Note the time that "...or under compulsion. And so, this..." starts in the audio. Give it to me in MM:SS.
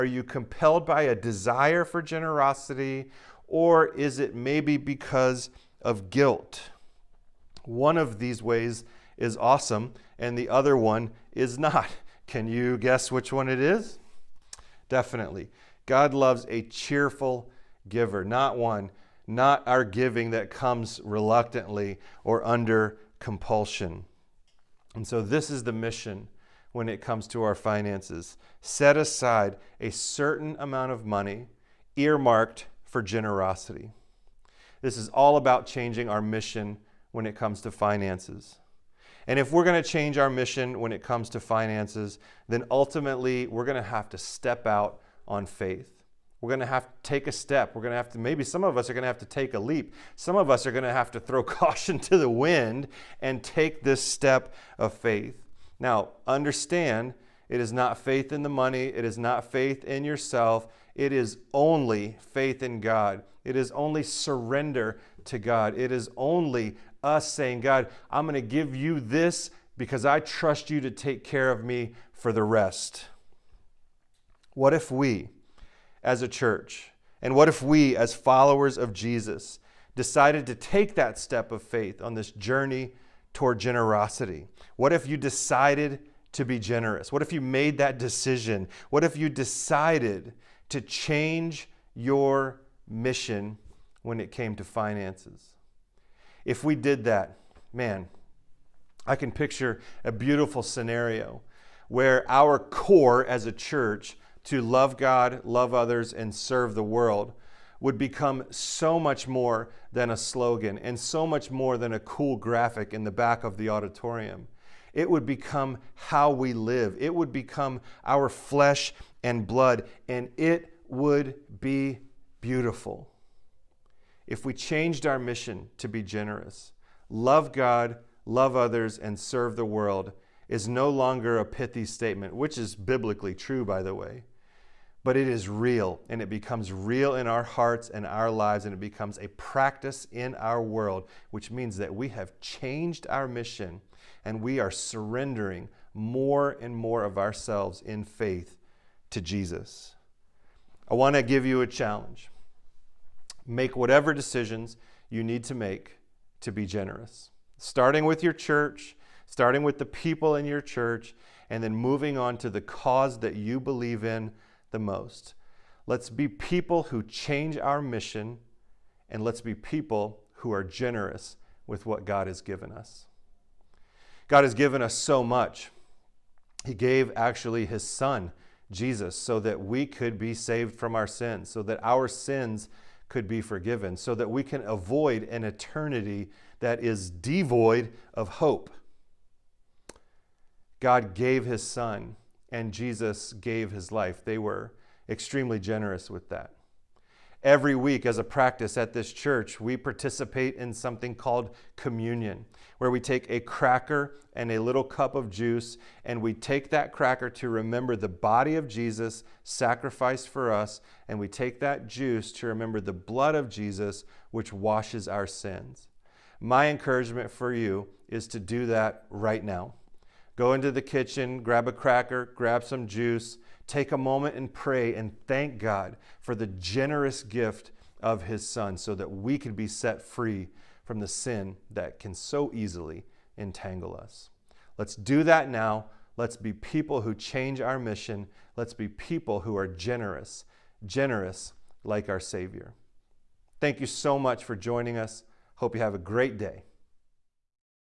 00:22.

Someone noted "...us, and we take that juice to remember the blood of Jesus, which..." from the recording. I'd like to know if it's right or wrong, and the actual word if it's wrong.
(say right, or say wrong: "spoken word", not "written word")
right.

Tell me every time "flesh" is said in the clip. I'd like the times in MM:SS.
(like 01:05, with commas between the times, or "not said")
01:58.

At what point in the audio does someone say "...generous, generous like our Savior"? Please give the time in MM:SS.
03:59.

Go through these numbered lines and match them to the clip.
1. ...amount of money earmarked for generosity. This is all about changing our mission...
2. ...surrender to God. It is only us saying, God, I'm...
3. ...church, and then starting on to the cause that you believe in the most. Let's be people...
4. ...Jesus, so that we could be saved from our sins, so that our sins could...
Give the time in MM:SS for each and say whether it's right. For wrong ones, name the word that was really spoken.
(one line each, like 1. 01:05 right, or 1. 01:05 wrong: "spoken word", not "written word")
1. 00:30 right
2. 01:04 right
3. 02:40 wrong: "moving", not "starting"
4. 02:58 right.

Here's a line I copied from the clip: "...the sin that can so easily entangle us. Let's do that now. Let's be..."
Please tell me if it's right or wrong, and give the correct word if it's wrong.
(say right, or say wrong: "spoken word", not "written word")
right.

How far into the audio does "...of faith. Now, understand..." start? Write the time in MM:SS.
00:54.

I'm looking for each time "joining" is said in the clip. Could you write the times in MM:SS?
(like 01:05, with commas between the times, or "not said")
04:04.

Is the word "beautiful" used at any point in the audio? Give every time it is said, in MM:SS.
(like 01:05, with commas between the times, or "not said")
01:40, 02:02.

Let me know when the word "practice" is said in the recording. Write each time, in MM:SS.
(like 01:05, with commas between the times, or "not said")
02:19, 03:18.